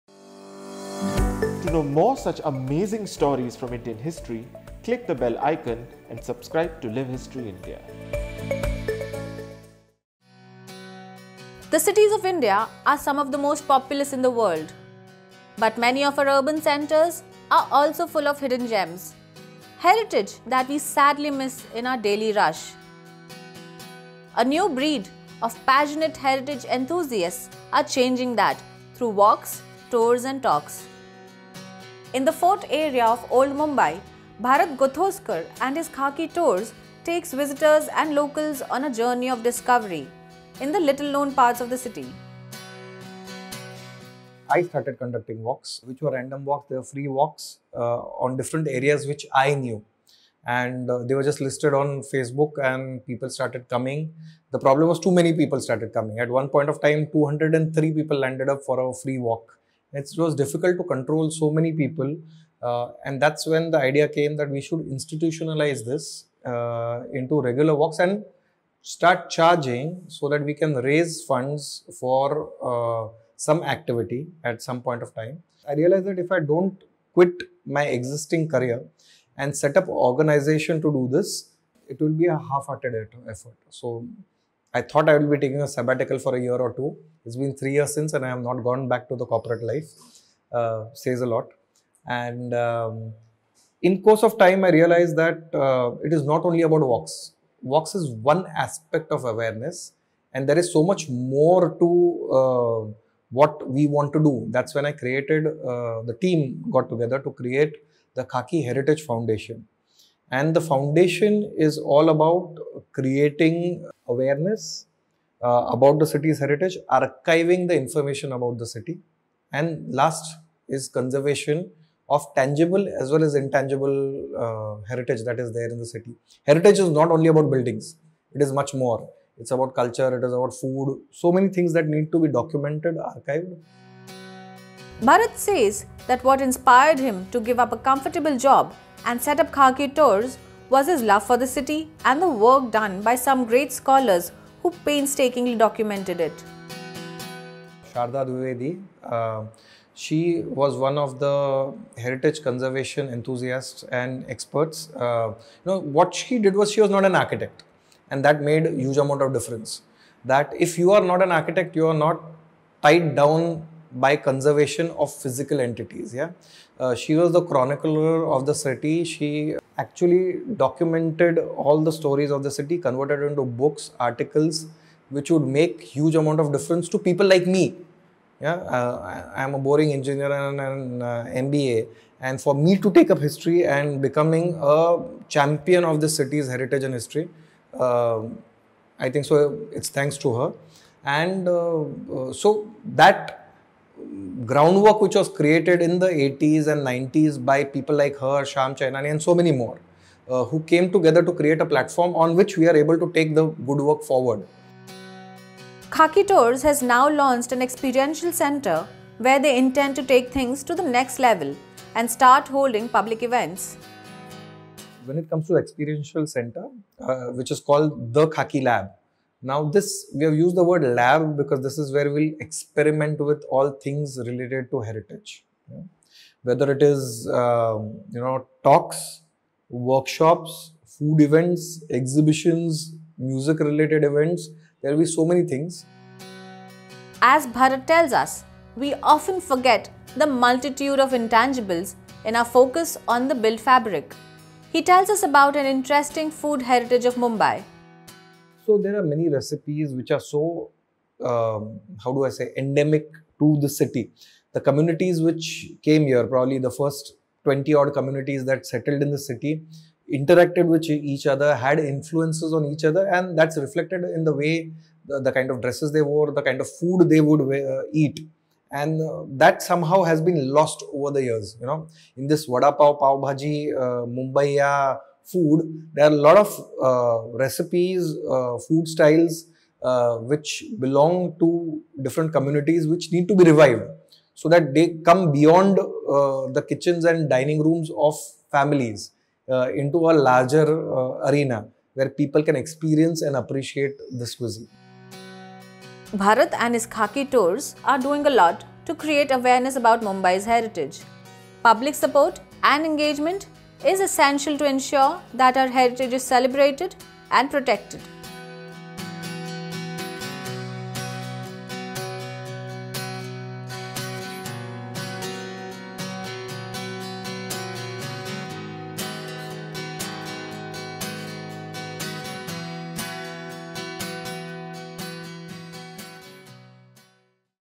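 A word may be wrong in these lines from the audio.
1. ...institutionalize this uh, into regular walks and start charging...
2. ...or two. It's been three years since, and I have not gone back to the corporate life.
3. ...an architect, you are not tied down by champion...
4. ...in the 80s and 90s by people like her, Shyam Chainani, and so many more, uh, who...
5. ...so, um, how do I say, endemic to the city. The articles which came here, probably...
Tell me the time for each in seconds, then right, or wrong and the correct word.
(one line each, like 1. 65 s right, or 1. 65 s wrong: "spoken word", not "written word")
1. 64 s right
2. 86 s right
3. 161 s wrong: "conservation", not "champion"
4. 195 s right
5. 250 s wrong: "communities", not "articles".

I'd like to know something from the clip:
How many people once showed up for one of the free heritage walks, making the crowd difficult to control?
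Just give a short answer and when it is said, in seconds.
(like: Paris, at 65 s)
203, at 57 s.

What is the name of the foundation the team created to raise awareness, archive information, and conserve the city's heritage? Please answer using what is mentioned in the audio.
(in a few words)
Khaki Heritage Foundation.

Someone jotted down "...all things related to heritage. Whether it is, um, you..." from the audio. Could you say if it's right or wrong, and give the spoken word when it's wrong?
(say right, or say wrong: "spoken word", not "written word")
right.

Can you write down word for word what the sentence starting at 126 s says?
Heritage is not only about buildings, it is much more.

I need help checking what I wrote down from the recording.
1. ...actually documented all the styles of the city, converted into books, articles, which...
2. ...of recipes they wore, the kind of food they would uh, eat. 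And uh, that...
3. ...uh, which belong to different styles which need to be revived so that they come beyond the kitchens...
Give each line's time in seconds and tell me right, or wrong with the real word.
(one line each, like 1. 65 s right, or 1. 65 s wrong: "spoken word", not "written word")
1. 169 s wrong: "stories", not "styles"
2. 265 s wrong: "dresses", not "recipes"
3. 279 s wrong: "communities", not "styles".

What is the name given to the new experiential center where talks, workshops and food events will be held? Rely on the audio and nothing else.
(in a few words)
Khaki Lab.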